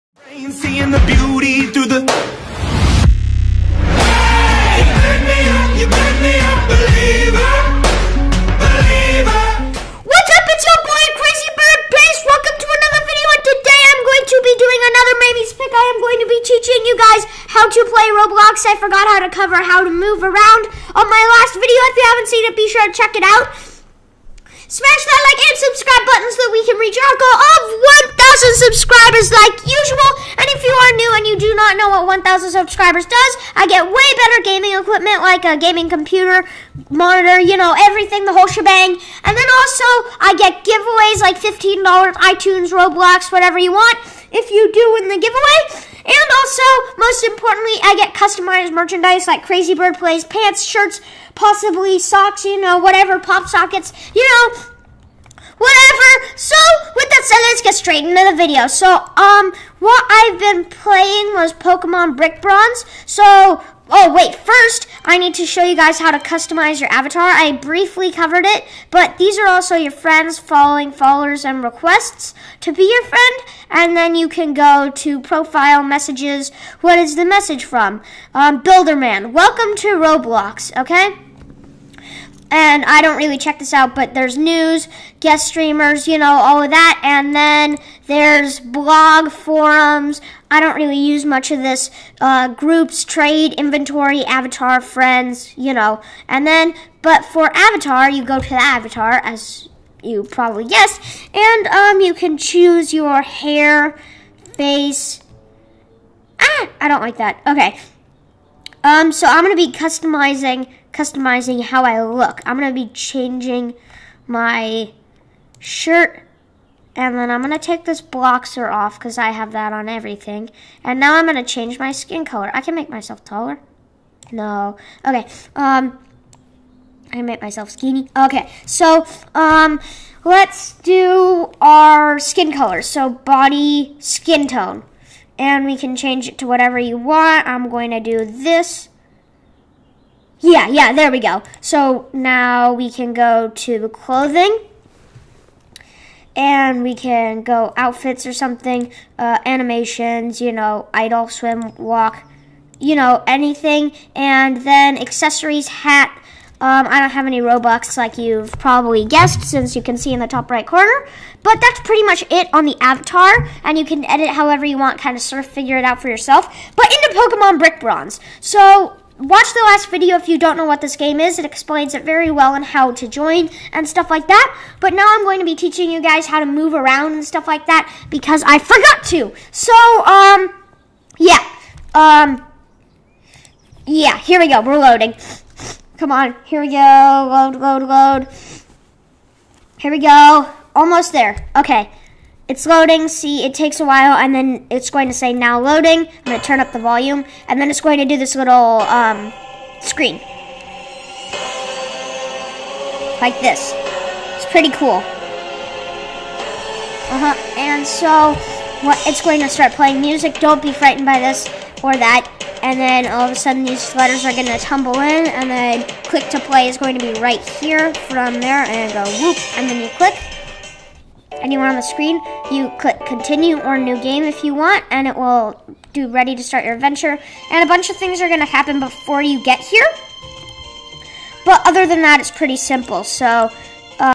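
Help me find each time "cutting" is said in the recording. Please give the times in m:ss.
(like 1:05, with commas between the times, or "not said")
not said.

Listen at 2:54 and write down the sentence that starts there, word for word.
But now I'm going to be teaching you guys how to move around and stuff like that because I forgot to.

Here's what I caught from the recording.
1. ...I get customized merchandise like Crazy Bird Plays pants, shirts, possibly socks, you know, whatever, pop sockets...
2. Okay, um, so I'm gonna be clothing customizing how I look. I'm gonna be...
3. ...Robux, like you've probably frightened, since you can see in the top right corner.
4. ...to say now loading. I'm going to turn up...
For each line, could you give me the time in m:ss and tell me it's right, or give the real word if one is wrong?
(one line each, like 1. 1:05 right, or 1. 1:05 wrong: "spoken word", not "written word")
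1. 0:47 right
2. 1:47 wrong: "customizing", not "clothing"
3. 2:37 wrong: "guessed", not "frightened"
4. 3:15 right.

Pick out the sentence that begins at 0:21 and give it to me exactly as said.
If you haven't seen it, be sure to check it out.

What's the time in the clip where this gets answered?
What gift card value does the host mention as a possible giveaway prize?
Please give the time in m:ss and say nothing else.
0:41.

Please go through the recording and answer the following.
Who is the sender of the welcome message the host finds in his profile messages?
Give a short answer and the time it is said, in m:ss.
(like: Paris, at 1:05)
Builderman, at 1:18.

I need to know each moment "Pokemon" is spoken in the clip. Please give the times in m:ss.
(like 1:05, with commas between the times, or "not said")
1:01, 2:47.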